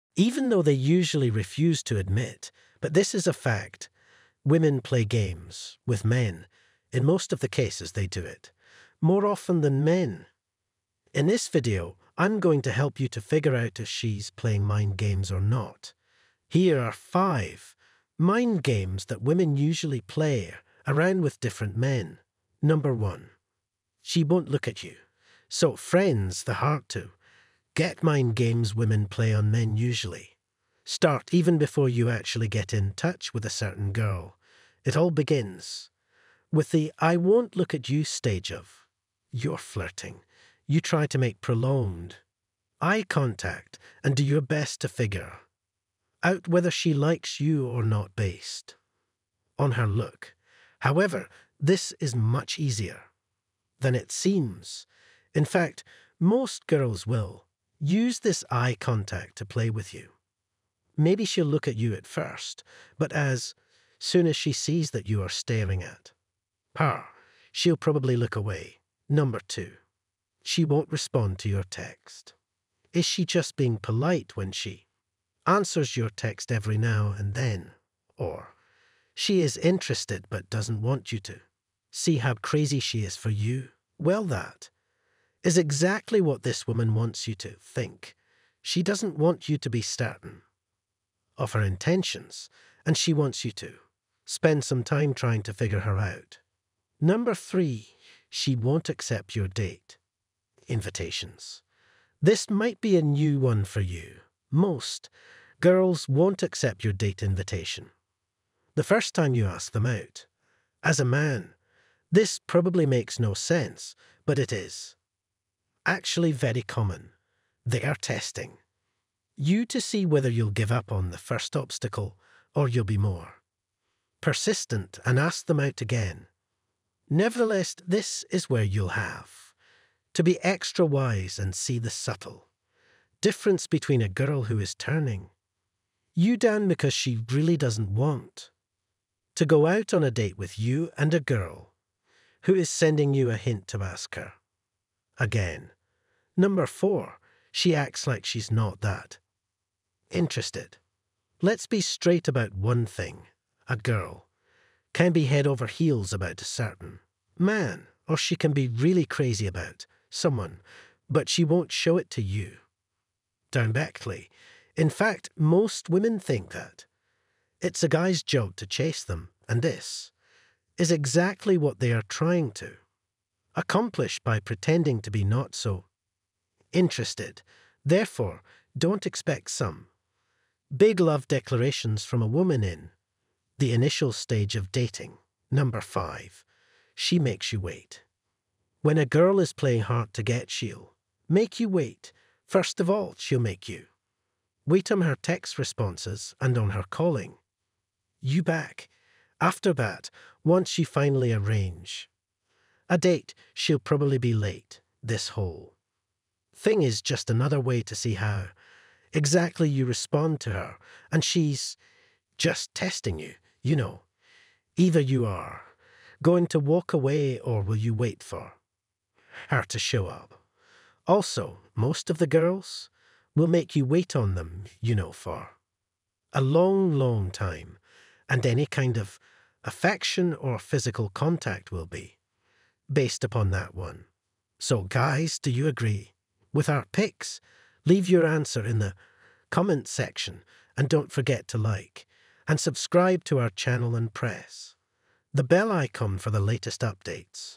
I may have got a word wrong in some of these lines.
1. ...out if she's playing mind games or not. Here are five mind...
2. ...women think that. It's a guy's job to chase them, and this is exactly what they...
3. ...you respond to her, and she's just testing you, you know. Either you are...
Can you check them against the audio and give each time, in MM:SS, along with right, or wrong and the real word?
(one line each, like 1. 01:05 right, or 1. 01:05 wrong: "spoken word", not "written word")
1. 00:13 right
2. 02:45 right
3. 03:29 right.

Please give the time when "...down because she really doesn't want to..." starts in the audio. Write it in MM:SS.
02:16.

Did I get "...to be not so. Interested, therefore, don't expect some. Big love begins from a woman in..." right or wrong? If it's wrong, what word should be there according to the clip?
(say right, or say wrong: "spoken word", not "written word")
wrong: "declarations", not "begins".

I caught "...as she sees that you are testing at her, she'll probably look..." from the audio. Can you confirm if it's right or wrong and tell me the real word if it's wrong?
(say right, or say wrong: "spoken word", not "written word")
wrong: "staring", not "testing".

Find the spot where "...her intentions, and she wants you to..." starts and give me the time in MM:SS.
01:31.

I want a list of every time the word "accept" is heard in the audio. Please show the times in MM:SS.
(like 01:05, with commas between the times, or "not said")
01:38, 01:46.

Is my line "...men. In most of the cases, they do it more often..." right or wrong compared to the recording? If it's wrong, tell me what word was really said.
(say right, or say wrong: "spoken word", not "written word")
right.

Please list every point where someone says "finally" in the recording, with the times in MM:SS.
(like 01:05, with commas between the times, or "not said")
03:20.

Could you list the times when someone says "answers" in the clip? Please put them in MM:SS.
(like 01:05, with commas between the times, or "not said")
01:15, 03:58.